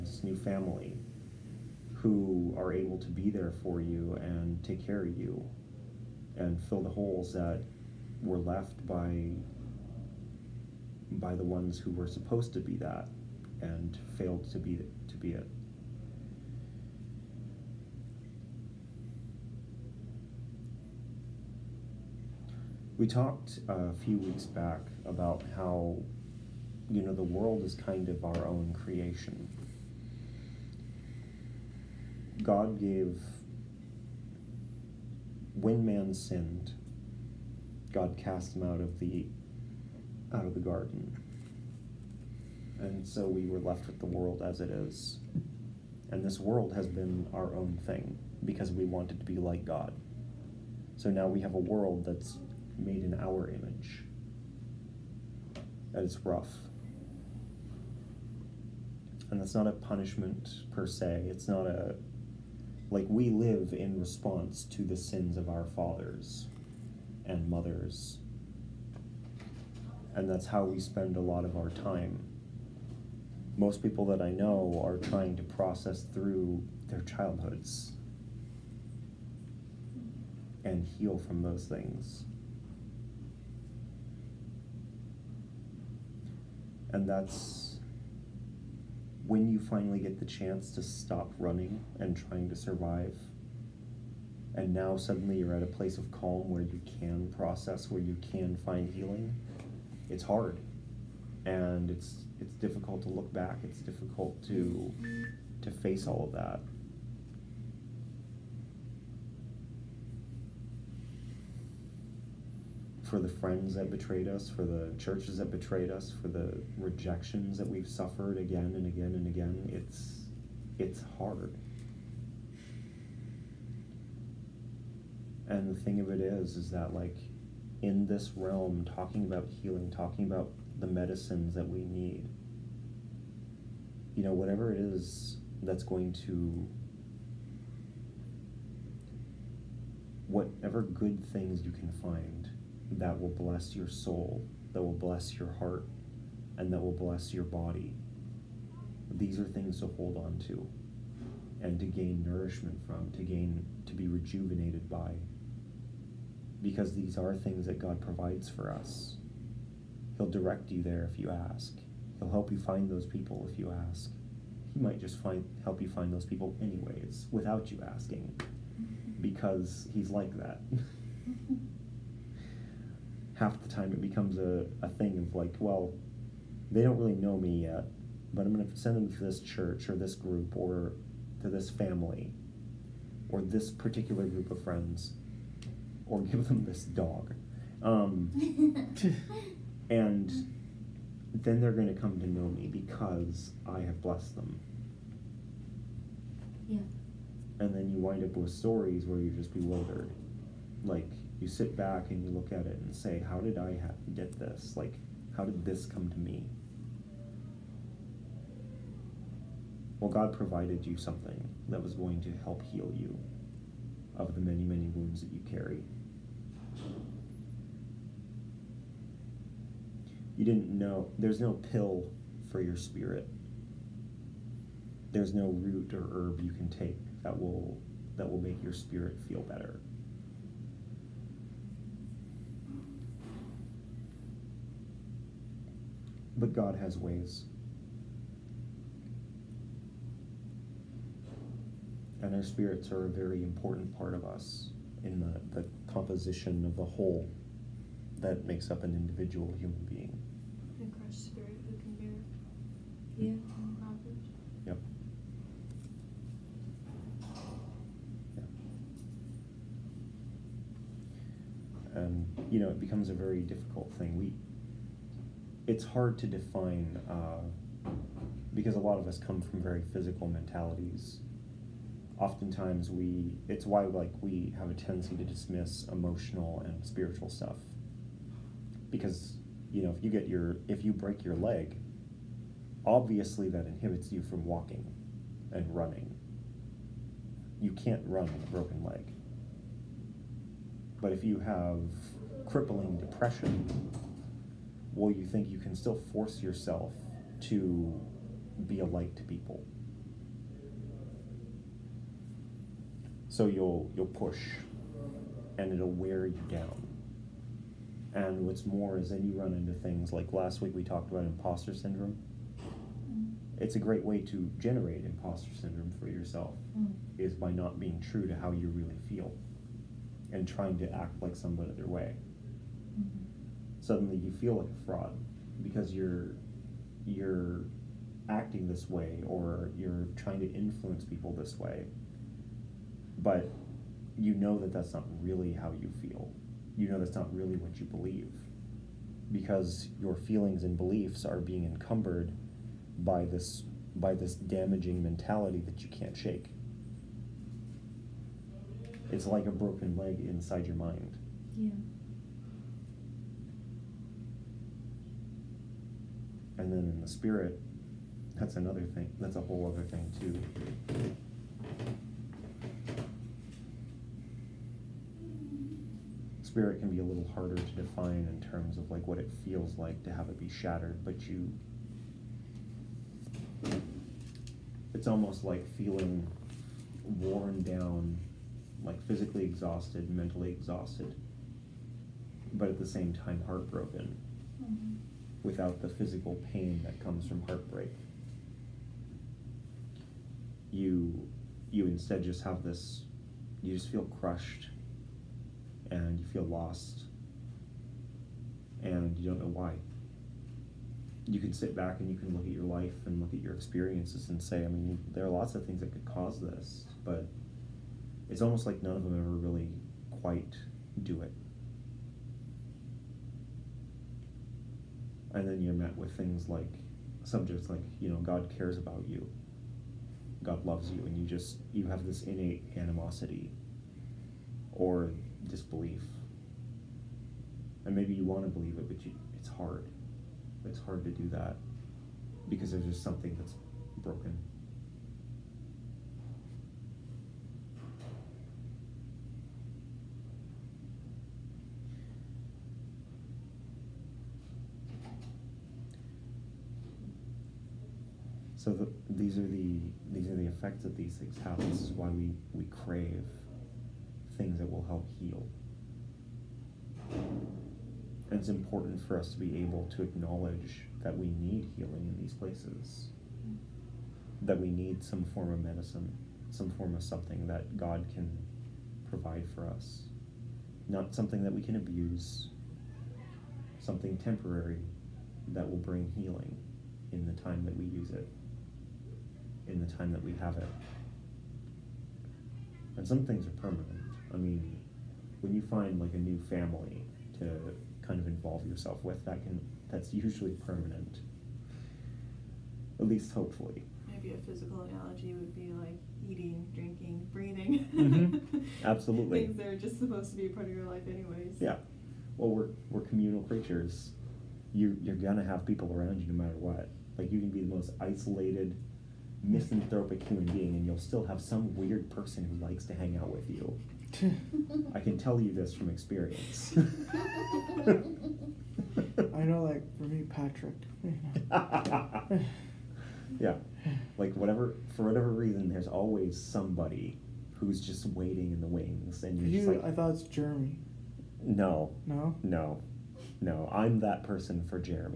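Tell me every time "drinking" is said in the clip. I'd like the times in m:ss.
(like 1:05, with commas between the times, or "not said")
8:16.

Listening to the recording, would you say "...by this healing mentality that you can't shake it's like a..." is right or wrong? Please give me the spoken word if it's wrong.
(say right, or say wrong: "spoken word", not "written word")
wrong: "damaging", not "healing".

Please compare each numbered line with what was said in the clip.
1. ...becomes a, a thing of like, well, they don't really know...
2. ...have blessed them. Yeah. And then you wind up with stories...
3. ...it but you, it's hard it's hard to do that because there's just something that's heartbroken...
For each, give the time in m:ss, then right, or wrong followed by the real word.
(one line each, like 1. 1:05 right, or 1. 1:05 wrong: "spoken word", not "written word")
1. 2:54 right
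2. 3:13 right
3. 7:08 wrong: "broken", not "heartbroken".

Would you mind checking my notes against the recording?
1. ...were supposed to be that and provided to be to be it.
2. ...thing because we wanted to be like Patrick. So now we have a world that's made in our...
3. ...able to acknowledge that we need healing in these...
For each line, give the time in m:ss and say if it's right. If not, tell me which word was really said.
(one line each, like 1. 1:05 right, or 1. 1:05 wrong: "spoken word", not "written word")
1. 0:11 wrong: "failed", not "provided"
2. 0:47 wrong: "God", not "Patrick"
3. 7:39 right.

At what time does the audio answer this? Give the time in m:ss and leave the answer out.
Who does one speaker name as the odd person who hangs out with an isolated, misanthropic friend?
8:40.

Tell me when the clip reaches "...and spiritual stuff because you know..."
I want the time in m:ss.
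4:36.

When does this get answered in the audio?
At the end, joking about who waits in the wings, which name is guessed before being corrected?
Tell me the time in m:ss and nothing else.
8:50.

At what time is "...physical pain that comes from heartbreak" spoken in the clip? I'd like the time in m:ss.
6:25.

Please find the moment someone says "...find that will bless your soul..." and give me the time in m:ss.
2:21.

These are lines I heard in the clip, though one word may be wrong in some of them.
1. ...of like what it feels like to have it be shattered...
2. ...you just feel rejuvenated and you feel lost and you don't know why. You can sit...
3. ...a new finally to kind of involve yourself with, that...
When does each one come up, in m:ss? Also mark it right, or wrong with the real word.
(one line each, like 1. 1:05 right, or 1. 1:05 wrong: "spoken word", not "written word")
1. 6:08 right
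2. 6:33 wrong: "crushed", not "rejuvenated"
3. 8:06 wrong: "family", not "finally".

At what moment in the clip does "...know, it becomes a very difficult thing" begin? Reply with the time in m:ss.
4:22.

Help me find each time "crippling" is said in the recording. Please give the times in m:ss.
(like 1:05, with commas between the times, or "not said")
4:52.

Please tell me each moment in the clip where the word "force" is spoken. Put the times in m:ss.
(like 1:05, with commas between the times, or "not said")
4:56.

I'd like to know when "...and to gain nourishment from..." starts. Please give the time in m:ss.
2:31.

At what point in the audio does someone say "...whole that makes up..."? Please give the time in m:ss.
4:06.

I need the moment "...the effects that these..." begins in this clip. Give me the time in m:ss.
7:30.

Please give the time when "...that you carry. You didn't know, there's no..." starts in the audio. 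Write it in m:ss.
3:35.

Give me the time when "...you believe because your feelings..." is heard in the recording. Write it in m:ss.
5:37.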